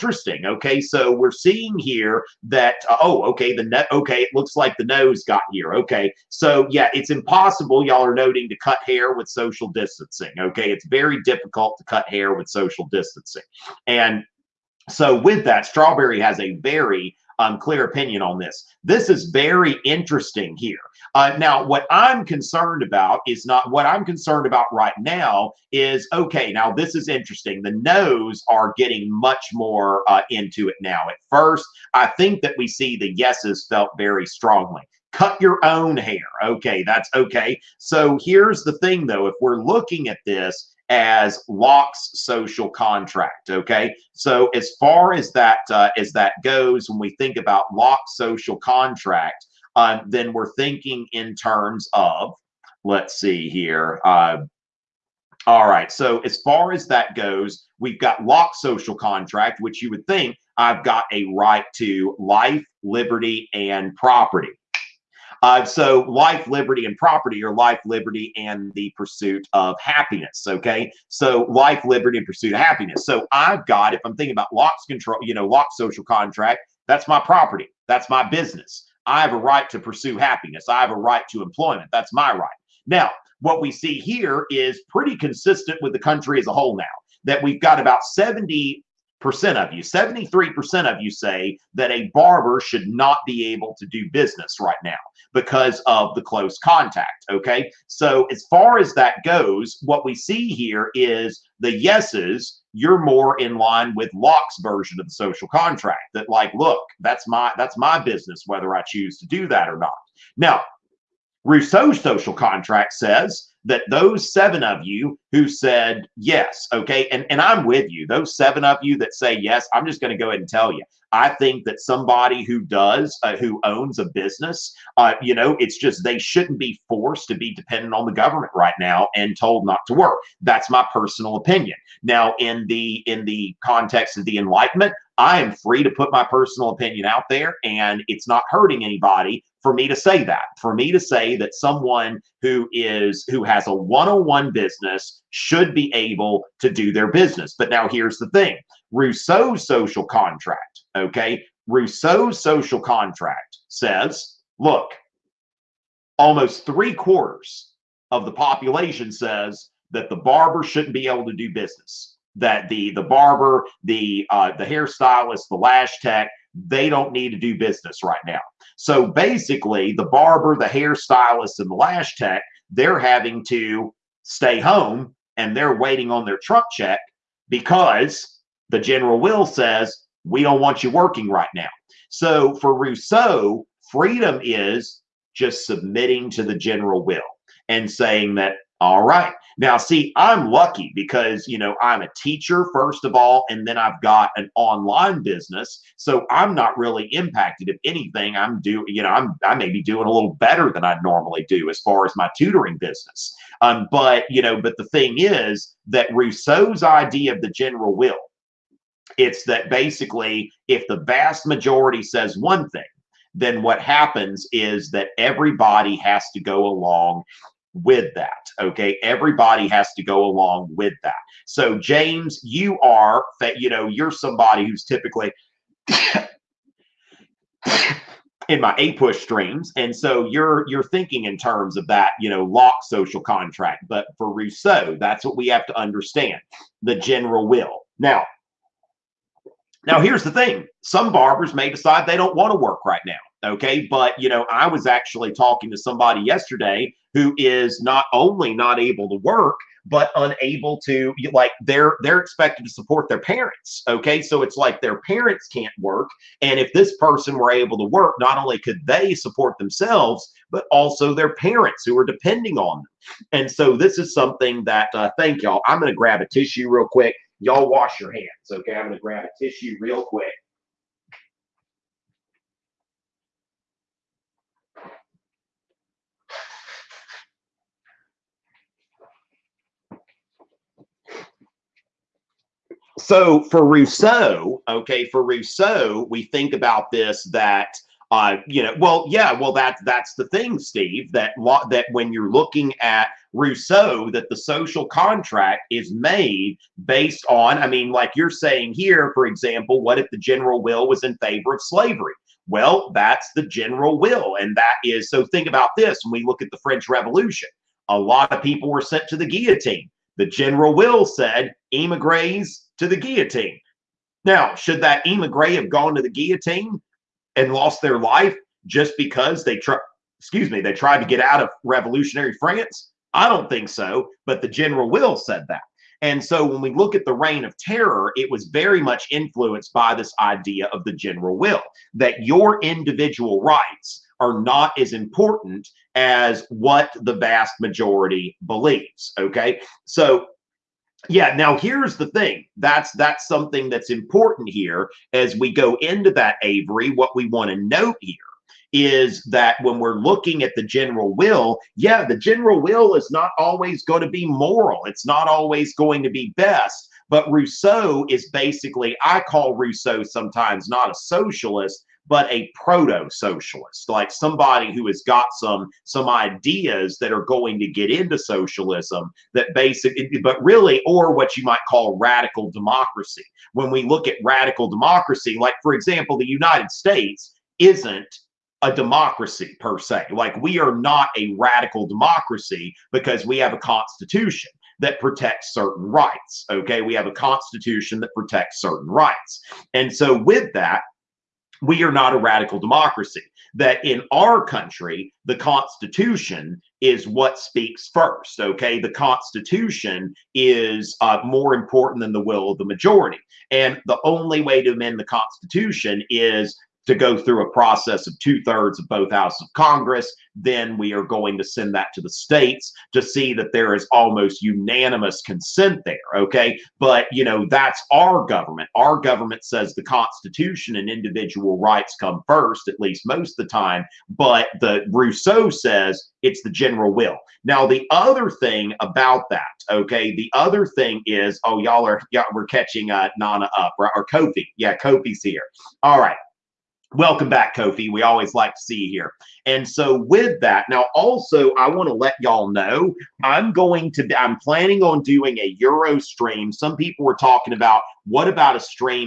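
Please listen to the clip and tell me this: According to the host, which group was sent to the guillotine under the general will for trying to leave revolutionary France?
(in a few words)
Emigres.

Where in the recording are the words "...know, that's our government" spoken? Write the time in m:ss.
6:57.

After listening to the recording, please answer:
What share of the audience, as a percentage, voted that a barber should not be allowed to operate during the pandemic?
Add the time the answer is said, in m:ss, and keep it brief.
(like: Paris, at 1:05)
73%, at 1:29.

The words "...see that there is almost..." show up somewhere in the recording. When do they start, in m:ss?
6:53.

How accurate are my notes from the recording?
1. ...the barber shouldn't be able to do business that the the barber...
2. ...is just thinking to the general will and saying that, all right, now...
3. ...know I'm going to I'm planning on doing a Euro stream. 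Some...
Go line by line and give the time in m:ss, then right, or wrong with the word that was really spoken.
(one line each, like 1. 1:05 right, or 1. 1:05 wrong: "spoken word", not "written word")
1. 2:40 right
2. 3:04 wrong: "submitting", not "thinking"
3. 7:22 right.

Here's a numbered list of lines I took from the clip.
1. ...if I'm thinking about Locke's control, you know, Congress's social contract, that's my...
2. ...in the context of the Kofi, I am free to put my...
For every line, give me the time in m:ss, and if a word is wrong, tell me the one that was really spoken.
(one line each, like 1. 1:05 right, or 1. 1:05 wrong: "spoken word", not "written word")
1. 1:13 wrong: "Locke", not "Congress"
2. 2:13 wrong: "Enlightenment", not "Kofi".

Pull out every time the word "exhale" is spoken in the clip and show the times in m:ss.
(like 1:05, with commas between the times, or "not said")
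not said.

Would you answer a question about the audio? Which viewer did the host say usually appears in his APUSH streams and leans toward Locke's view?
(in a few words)
James.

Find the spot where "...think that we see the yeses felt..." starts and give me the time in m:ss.
0:32.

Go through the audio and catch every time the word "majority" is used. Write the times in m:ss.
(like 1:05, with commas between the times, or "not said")
3:31, 5:37, 6:42.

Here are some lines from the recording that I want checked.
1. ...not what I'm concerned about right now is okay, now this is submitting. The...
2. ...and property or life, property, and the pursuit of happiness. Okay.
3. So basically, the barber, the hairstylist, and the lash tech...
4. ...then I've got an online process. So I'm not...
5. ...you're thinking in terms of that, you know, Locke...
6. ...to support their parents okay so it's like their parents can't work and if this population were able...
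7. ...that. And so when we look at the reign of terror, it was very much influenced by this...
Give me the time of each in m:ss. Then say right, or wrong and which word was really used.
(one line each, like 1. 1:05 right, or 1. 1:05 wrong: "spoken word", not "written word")
1. 0:23 wrong: "interesting", not "submitting"
2. 1:06 wrong: "liberty", not "property"
3. 2:48 right
4. 3:13 wrong: "business", not "process"
5. 3:50 right
6. 4:12 wrong: "person", not "population"
7. 5:25 right.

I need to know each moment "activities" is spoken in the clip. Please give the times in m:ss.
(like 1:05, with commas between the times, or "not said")
not said.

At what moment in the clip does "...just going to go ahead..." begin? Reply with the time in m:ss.
1:59.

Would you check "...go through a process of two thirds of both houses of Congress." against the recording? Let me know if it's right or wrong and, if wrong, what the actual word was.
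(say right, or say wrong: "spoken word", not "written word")
right.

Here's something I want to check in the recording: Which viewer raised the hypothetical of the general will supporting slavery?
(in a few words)
Steve.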